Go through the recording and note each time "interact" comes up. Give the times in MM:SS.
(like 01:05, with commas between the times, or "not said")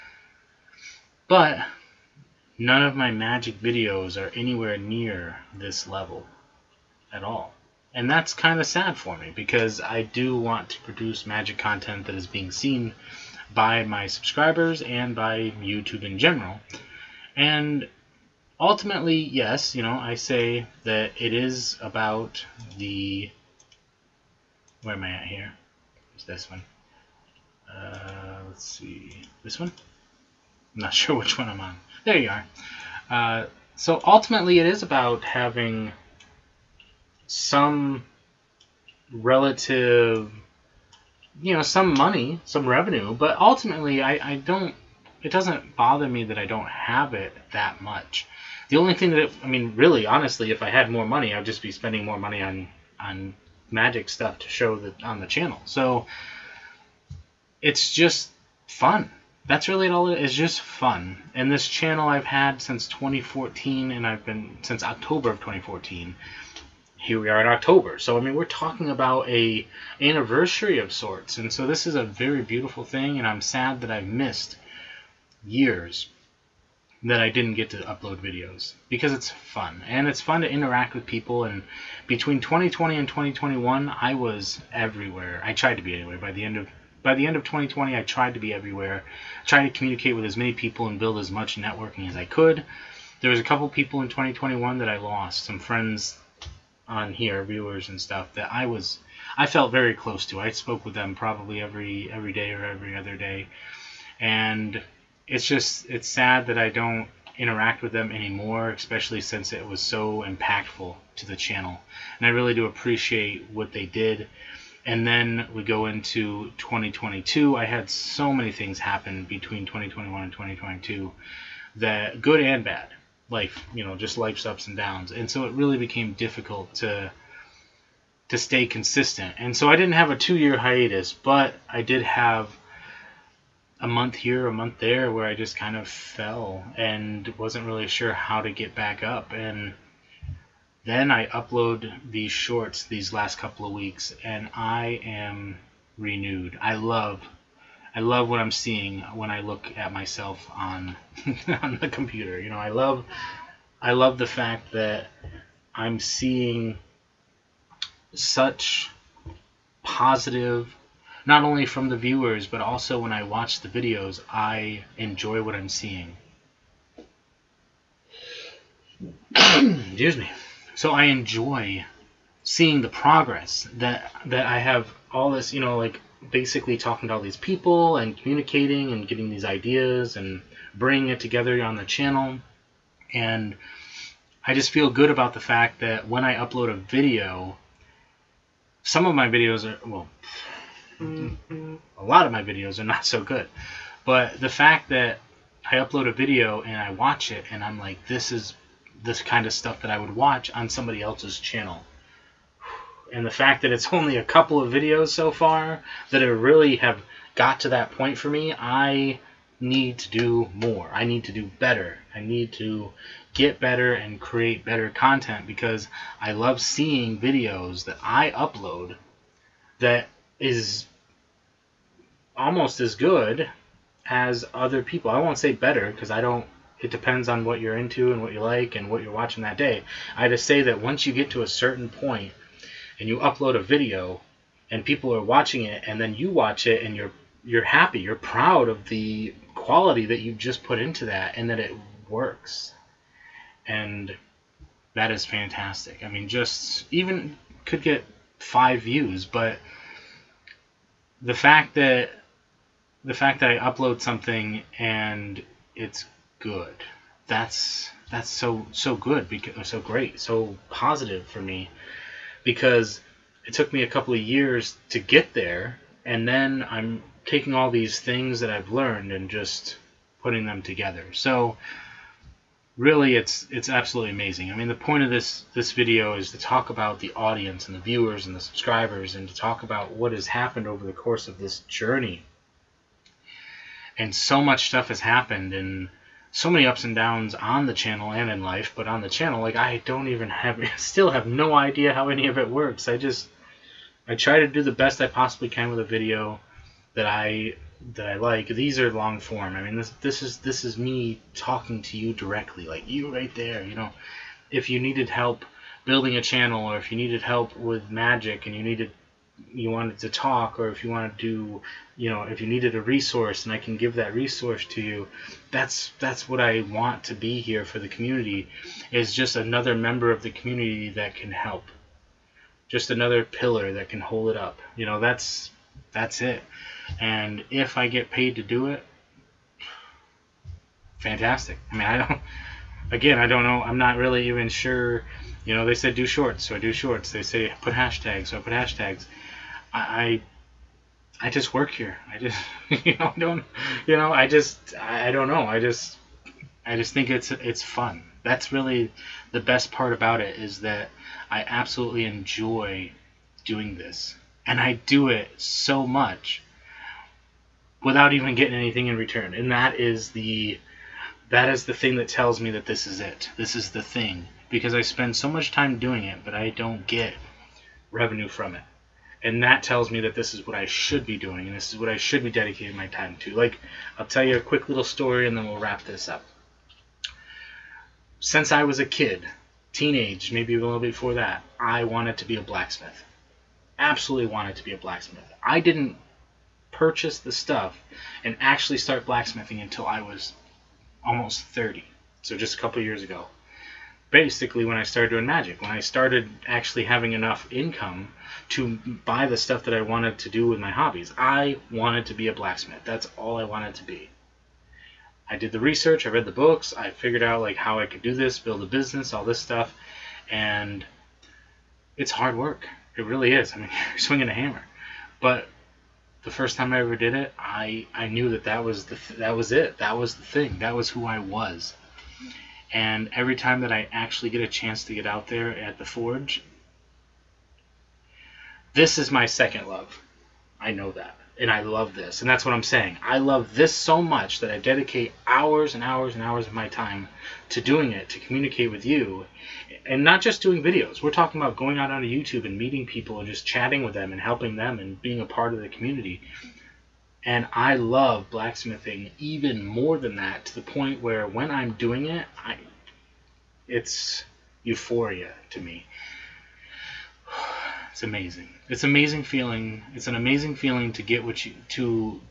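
01:20, 01:47.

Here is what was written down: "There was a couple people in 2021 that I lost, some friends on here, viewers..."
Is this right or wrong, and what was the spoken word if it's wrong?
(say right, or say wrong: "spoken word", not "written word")
right.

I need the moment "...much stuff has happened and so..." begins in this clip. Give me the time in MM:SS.
04:44.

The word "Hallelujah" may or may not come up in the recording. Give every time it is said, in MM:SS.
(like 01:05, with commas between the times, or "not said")
not said.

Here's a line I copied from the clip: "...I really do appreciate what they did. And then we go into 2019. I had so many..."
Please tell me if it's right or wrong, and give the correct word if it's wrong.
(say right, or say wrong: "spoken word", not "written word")
wrong: "2022", not "2019".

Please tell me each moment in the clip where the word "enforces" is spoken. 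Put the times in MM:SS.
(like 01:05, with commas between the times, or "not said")
not said.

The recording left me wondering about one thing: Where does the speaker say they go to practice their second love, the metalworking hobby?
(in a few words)
The forge.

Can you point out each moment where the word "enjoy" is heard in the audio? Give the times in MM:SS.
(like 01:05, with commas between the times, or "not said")
02:44, 02:51, 05:52.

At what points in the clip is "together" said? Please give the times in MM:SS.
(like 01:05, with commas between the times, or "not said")
03:01, 04:30.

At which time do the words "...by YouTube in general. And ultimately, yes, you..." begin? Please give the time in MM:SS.
00:15.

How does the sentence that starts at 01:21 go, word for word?
And between 2020 and 2021, I was everywhere.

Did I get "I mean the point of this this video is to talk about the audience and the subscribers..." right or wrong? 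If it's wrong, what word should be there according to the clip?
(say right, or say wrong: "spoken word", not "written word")
wrong: "viewers", not "subscribers".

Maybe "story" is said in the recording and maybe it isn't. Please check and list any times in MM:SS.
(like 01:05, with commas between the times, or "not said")
06:14.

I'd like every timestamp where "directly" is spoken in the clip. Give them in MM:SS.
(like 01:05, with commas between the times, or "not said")
05:02.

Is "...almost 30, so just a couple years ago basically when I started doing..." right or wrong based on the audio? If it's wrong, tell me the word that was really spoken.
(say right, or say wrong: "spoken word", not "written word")
right.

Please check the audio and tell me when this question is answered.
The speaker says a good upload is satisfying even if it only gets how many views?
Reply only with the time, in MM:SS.
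04:08.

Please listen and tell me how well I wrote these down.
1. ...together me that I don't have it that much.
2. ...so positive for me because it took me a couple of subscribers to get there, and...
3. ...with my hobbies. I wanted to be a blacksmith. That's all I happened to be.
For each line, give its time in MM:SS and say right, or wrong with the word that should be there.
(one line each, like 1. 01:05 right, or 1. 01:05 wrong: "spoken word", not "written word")
1. 00:45 wrong: "bother", not "together"
2. 04:20 wrong: "years", not "subscribers"
3. 06:40 wrong: "wanted", not "happened".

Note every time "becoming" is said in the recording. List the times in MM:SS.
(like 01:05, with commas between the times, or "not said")
not said.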